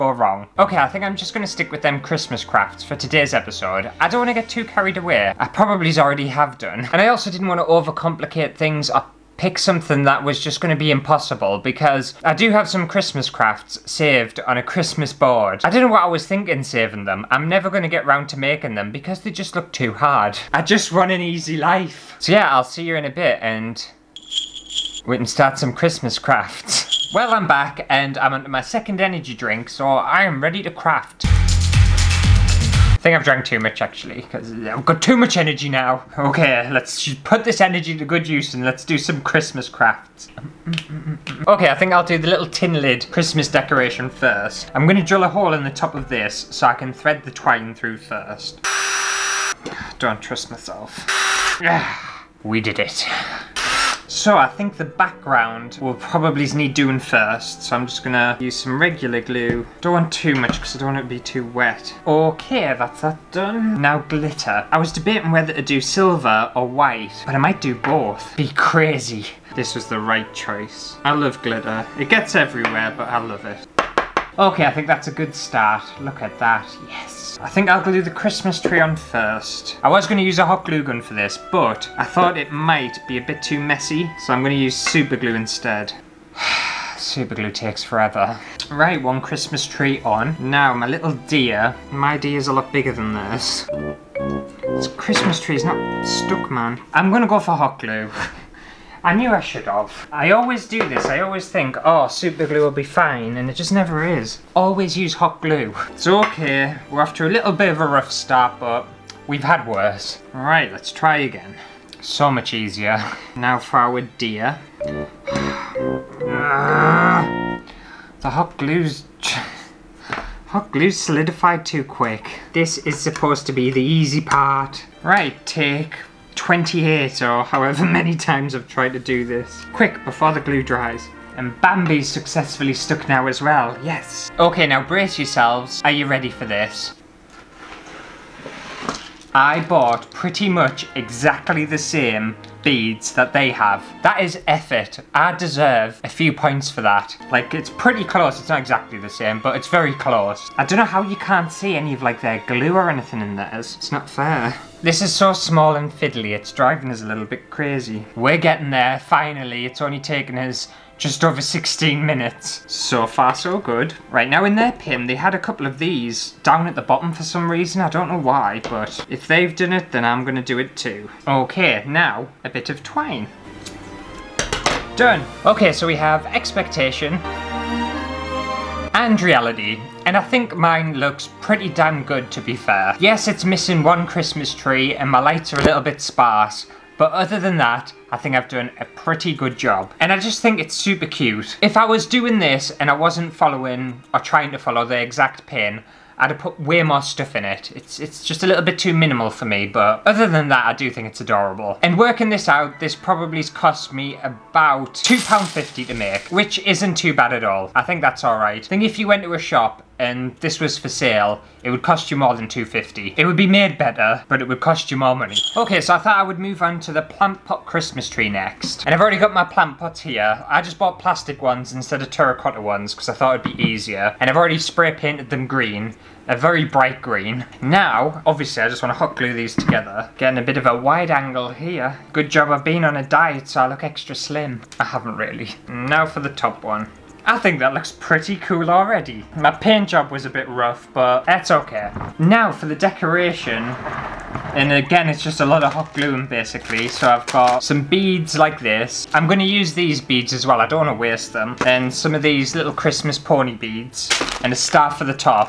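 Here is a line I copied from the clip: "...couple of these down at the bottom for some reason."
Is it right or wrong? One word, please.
right.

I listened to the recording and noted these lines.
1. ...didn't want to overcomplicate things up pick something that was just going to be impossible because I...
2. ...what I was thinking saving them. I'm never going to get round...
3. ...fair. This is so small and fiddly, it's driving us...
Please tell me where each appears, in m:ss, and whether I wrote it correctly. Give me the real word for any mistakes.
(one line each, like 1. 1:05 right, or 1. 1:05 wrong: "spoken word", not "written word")
1. 0:07 right
2. 0:15 right
3. 2:34 right.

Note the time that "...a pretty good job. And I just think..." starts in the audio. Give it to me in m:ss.
3:08.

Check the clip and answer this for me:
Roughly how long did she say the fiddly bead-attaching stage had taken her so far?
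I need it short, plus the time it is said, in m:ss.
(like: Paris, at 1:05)
just over 16 minutes, at 2:40.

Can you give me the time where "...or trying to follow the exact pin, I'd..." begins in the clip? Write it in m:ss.
3:14.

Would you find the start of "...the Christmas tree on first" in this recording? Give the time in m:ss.
1:18.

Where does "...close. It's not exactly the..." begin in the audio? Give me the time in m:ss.
2:28.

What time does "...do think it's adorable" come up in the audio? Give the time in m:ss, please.
3:20.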